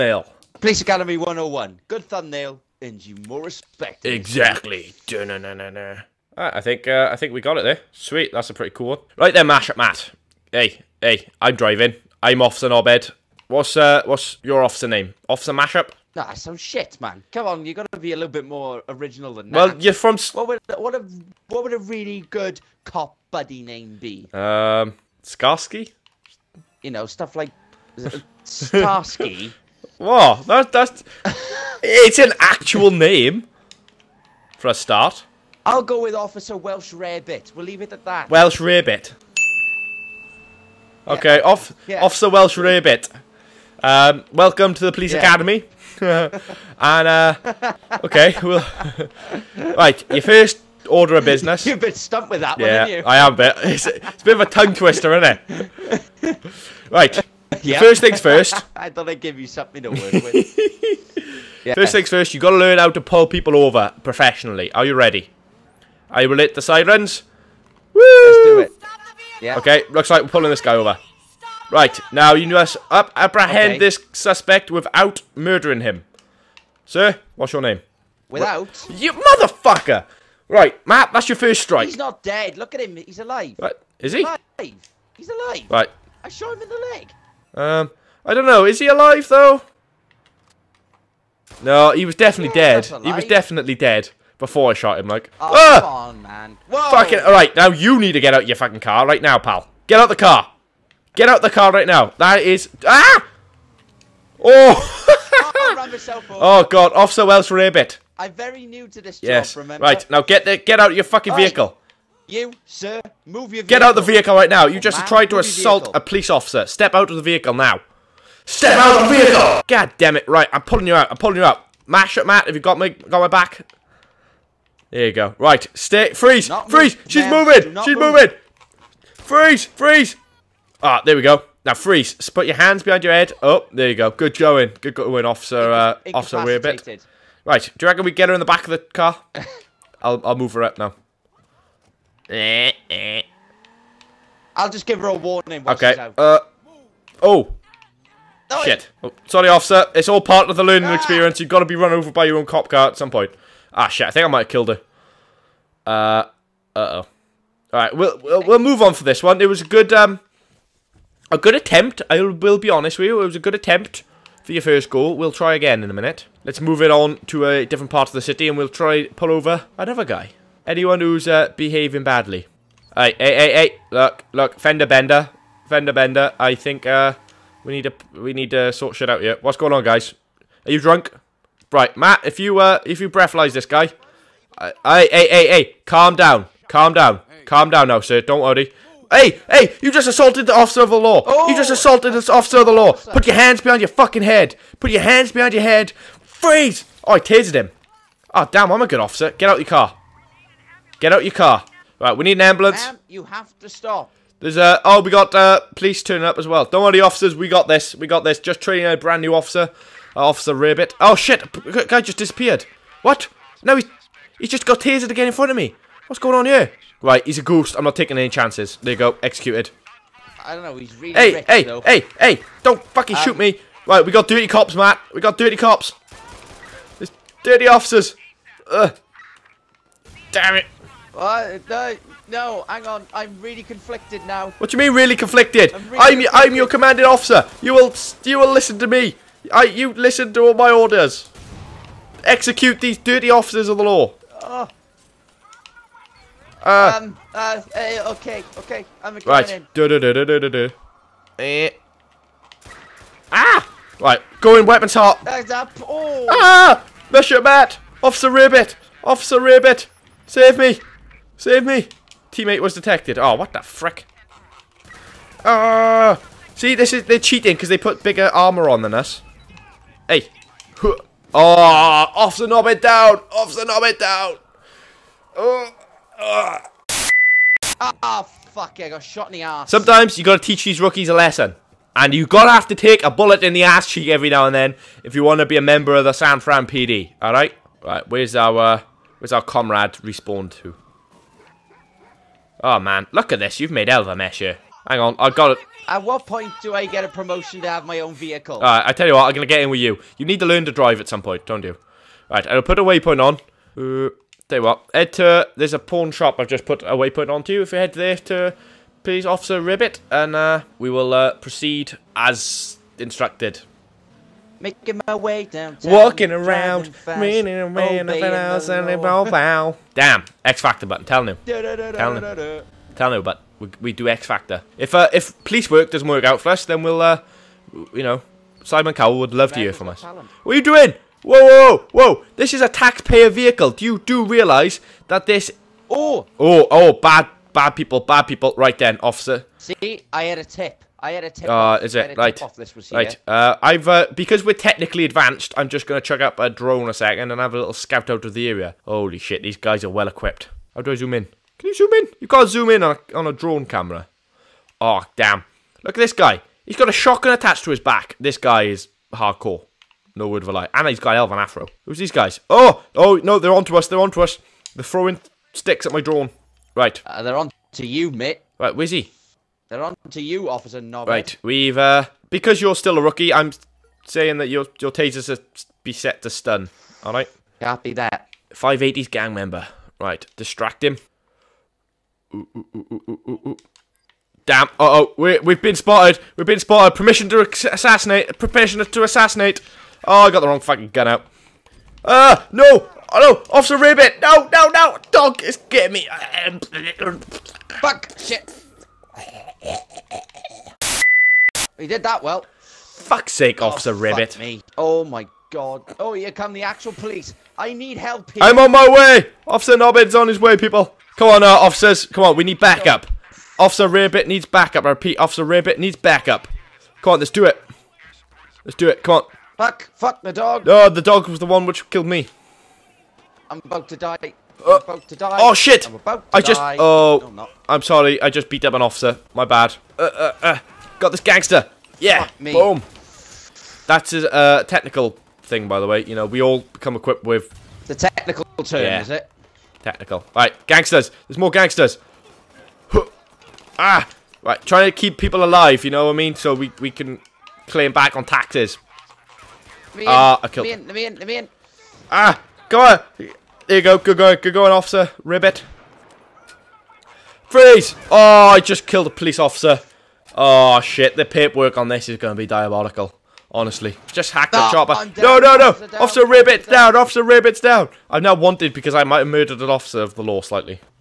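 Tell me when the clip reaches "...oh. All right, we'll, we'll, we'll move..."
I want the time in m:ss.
2:36.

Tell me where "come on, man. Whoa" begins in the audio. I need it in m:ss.
1:35.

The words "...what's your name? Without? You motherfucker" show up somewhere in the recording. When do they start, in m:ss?
1:17.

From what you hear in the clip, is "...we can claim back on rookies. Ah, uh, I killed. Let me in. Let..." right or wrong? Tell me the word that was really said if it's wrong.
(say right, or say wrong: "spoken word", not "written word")
wrong: "taxes", not "rookies".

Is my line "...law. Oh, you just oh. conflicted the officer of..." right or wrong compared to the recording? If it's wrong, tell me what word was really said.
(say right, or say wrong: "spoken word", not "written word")
wrong: "assaulted", not "conflicted".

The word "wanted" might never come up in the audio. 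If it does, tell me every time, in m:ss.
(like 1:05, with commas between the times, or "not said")
7:48.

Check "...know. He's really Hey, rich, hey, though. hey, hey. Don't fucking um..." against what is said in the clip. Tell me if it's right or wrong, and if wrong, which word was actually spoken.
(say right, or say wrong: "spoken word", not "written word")
right.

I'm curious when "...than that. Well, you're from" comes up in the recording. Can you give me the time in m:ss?
0:19.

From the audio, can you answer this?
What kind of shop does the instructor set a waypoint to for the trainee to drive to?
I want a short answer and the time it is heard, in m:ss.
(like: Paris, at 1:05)
pawn shop, at 5:05.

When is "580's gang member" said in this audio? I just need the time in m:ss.
6:18.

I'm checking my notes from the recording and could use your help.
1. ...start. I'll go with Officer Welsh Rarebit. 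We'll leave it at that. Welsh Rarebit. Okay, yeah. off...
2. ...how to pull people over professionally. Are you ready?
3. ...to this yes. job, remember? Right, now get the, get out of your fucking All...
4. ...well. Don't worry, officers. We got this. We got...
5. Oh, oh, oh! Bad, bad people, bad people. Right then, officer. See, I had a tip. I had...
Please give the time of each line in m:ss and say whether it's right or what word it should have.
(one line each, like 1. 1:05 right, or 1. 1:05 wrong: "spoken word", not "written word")
1. 0:34 right
2. 1:02 right
3. 1:48 right
4. 3:26 right
5. 5:35 right.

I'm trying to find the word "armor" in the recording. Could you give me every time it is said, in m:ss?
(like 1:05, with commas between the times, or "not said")
4:28.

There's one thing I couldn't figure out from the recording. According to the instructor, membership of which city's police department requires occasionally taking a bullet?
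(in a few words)
San Fran PD.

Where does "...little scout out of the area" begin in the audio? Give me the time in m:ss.
5:47.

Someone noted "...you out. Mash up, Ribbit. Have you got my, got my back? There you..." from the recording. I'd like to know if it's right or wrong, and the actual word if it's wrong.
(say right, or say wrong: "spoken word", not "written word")
wrong: "Matt", not "Ribbit".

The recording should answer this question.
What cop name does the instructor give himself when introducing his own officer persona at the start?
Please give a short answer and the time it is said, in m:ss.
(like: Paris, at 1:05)
Officer Knobhead, at 0:12.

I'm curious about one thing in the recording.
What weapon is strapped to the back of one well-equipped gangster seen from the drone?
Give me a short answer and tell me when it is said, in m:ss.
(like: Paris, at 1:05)
shotgun, at 5:56.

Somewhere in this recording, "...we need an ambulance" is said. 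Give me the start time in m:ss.
3:22.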